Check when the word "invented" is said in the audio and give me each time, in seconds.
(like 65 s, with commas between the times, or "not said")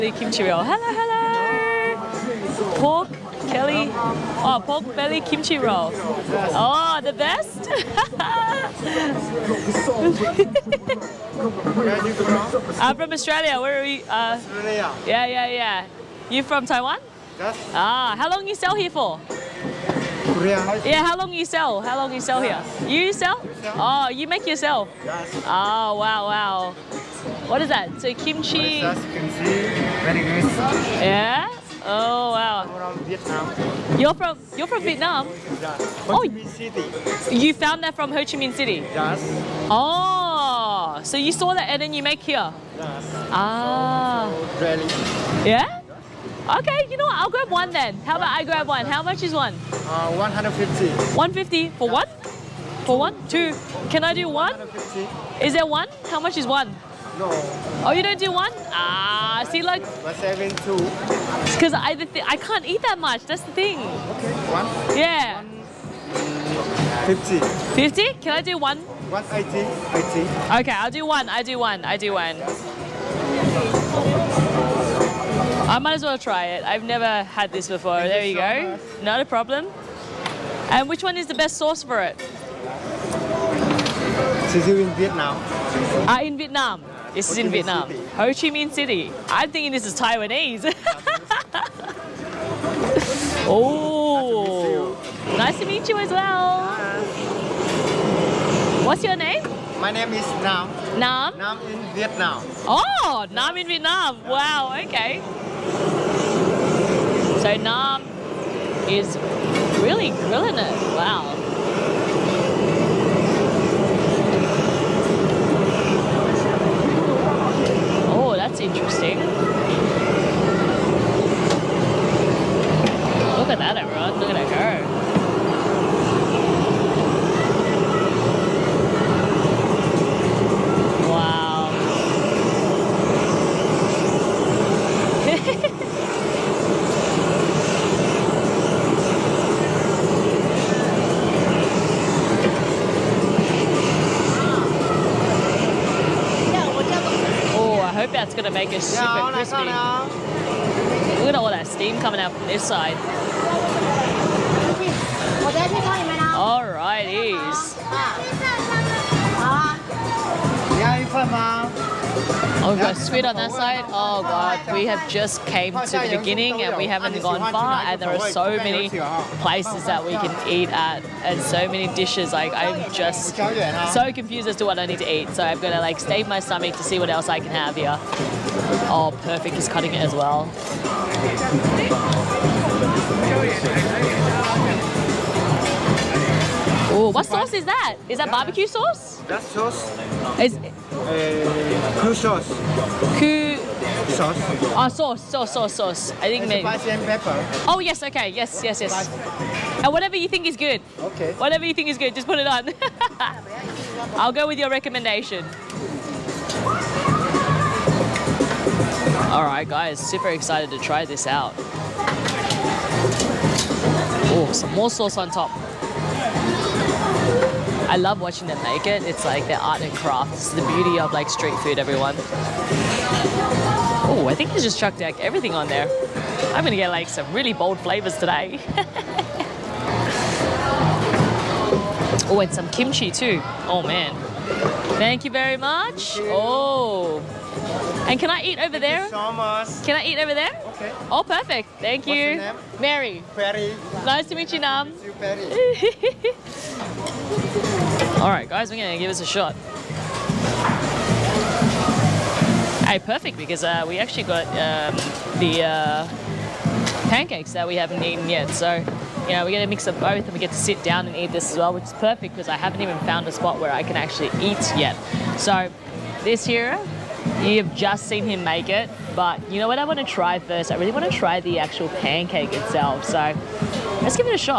not said.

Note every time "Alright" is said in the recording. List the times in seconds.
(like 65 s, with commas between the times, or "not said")
209 s.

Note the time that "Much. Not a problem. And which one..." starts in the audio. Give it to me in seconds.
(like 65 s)
78 s.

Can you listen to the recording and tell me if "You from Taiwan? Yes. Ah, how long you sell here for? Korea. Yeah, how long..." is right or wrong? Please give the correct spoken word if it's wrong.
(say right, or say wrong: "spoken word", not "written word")
right.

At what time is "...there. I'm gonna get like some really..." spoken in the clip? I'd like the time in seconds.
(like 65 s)
225 s.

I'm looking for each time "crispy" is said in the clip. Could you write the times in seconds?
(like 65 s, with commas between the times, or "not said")
149 s.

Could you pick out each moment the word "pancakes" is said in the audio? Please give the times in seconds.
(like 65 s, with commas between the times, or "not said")
257 s, 271 s.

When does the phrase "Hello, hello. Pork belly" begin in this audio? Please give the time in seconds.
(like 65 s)
0 s.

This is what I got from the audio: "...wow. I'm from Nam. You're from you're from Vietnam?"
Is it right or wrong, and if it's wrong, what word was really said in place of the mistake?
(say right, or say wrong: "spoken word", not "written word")
wrong: "Vietnam", not "Nam".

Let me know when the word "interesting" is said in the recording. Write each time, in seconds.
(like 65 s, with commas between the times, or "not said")
118 s.